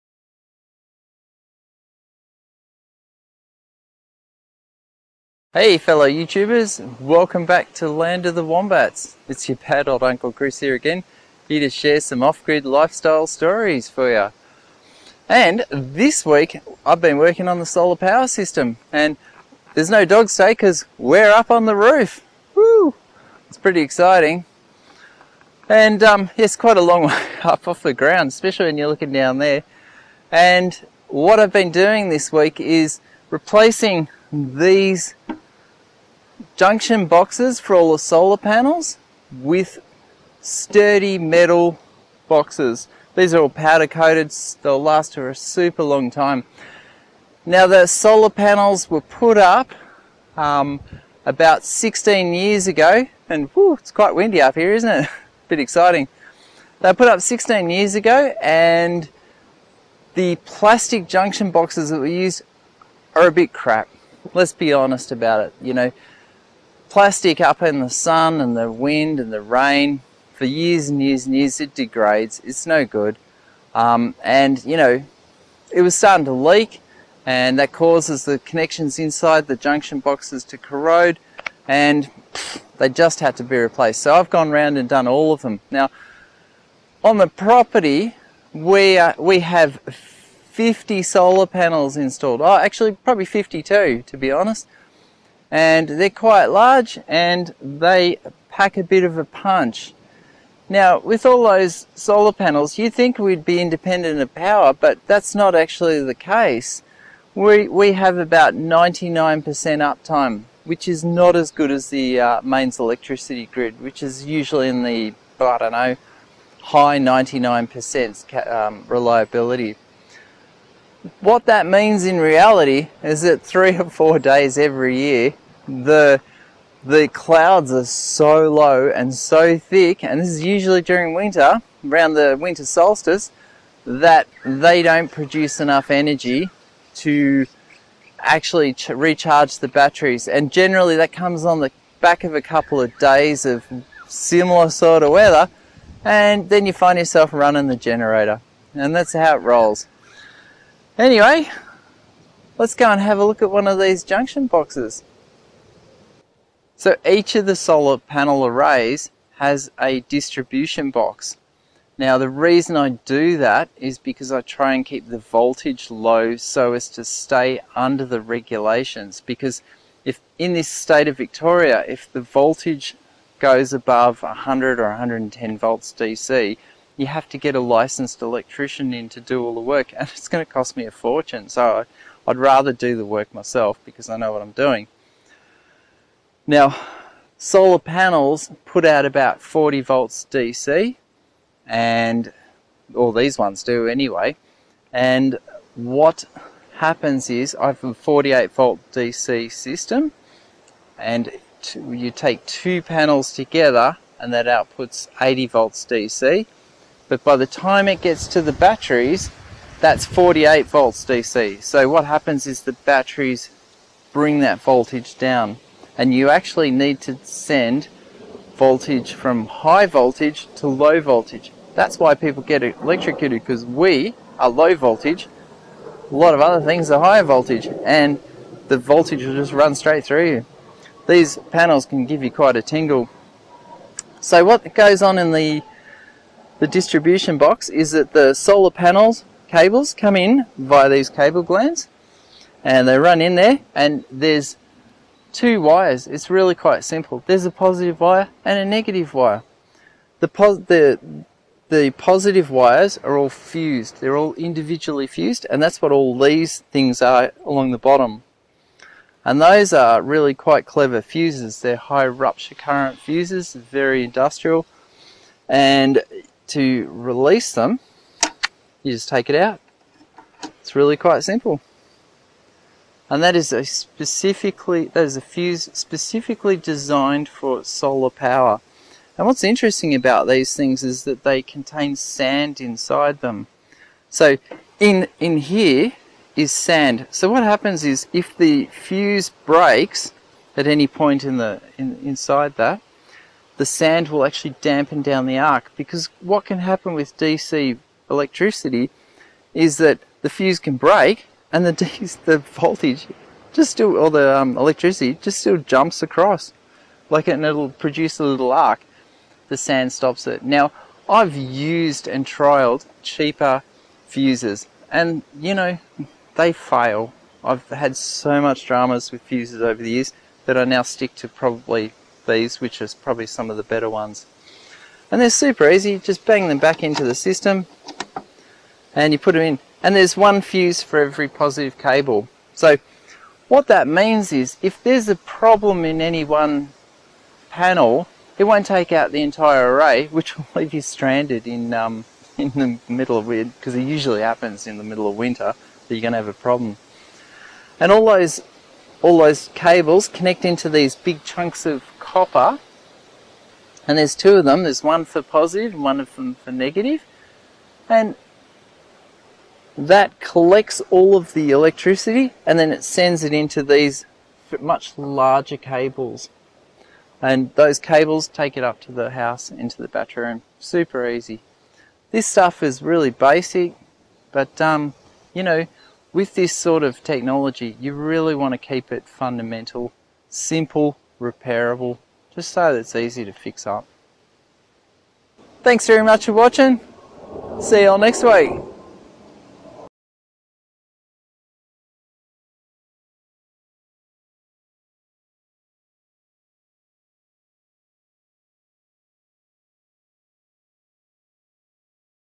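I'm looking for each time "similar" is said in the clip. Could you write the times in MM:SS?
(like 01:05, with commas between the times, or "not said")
02:24.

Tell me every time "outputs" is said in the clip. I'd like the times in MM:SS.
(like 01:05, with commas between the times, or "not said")
03:24.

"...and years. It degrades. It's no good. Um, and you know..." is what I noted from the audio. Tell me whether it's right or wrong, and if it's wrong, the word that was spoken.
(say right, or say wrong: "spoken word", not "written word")
right.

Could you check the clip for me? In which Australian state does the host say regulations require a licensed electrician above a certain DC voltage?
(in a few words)
Victoria.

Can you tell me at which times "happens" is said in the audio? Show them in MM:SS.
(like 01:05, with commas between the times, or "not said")
03:16, 03:32, 04:47, 04:56, 05:44.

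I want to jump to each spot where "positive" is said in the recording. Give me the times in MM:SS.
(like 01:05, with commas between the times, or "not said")
04:07, 04:11, 05:31, 05:55.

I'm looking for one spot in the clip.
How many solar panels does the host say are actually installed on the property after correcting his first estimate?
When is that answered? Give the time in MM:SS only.
01:33.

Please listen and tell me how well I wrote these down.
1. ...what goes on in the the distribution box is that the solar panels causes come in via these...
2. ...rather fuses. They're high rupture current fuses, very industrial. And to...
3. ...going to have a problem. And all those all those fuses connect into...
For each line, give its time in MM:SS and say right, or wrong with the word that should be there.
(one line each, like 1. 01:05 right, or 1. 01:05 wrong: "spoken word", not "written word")
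1. 03:54 wrong: "cables", not "causes"
2. 04:20 wrong: "clever", not "rather"
3. 05:46 wrong: "cables", not "fuses".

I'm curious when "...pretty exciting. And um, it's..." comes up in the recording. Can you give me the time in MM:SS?
00:23.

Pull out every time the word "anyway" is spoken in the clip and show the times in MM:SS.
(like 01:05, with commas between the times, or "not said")
02:30, 03:13.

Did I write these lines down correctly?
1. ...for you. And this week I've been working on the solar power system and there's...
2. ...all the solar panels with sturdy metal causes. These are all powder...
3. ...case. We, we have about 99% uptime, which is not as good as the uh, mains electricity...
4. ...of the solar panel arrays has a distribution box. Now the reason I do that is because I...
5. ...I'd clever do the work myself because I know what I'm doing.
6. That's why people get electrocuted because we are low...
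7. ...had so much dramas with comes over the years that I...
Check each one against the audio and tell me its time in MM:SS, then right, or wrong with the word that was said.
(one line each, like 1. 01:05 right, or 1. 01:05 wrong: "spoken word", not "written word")
1. 00:13 right
2. 00:37 wrong: "boxes", not "causes"
3. 01:46 right
4. 02:37 right
5. 03:02 wrong: "rather", not "clever"
6. 03:41 right
7. 05:17 wrong: "fuses", not "comes".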